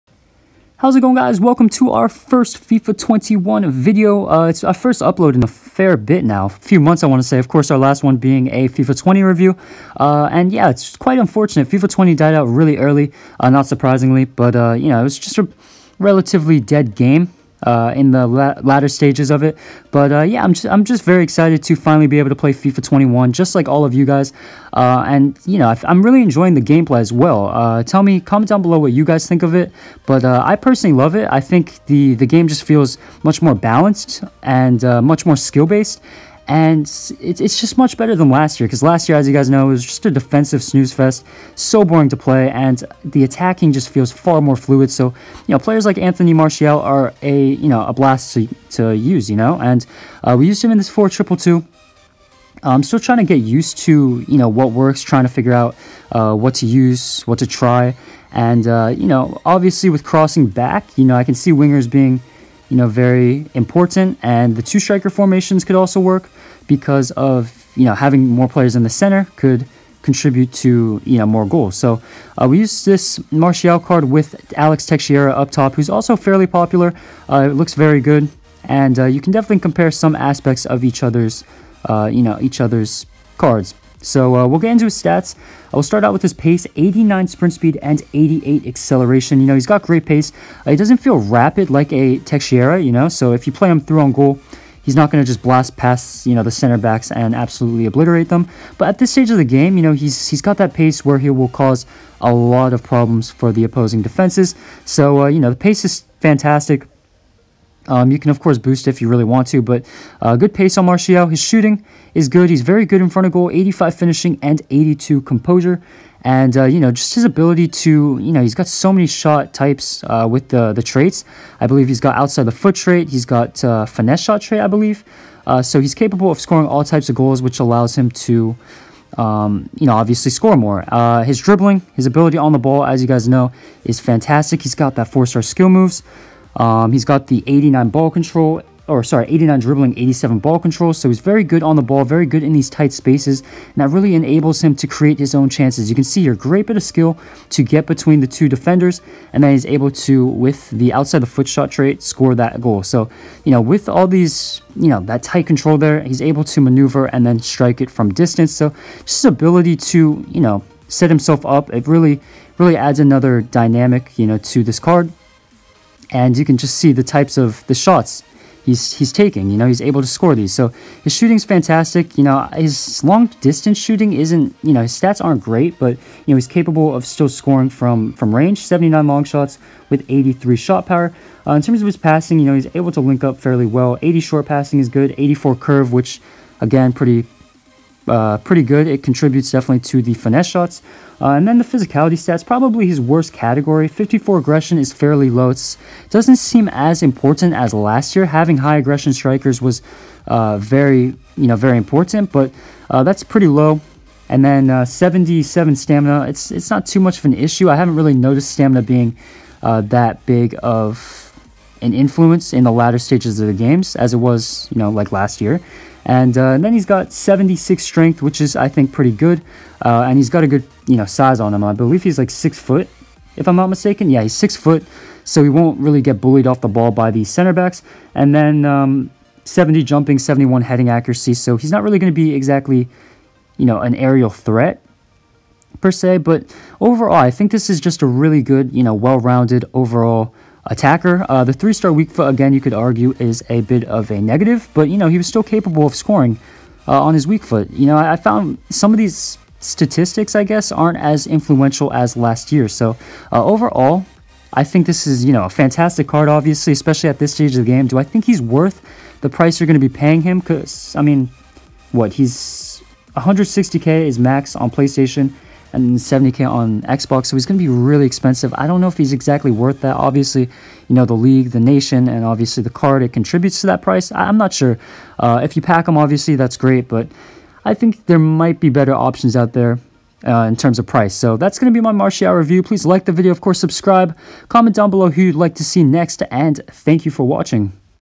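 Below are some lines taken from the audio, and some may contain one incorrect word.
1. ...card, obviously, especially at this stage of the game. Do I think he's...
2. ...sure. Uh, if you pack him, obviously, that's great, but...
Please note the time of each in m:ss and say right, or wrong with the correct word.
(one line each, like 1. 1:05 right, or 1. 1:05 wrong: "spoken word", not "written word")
1. 4:16 right
2. 4:34 right.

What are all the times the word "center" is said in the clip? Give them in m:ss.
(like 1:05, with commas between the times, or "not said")
1:08, 1:36, 3:47.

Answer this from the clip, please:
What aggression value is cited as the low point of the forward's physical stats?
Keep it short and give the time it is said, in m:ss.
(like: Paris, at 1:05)
54, at 3:13.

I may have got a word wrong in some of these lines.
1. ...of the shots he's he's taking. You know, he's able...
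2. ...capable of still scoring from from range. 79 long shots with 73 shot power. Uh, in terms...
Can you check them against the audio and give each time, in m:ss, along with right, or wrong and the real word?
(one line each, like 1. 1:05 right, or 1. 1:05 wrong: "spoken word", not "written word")
1. 2:47 right
2. 2:56 wrong: "83", not "73".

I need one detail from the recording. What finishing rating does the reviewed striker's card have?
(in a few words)
85.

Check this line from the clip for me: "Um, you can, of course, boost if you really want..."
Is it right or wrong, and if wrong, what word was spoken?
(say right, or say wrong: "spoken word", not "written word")
right.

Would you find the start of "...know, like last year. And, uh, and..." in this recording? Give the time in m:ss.
3:34.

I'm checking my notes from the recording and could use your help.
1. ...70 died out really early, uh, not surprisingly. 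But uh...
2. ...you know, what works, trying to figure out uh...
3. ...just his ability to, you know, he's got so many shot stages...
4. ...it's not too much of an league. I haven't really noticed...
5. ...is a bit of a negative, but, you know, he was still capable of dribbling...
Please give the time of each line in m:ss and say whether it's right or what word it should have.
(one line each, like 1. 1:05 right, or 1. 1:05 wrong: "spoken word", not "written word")
1. 0:11 wrong: "20", not "70"
2. 0:54 right
3. 1:56 wrong: "types", not "stages"
4. 3:26 wrong: "issue", not "league"
5. 4:03 wrong: "scoring", not "dribbling".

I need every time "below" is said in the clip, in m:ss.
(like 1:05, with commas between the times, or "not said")
0:28, 4:44.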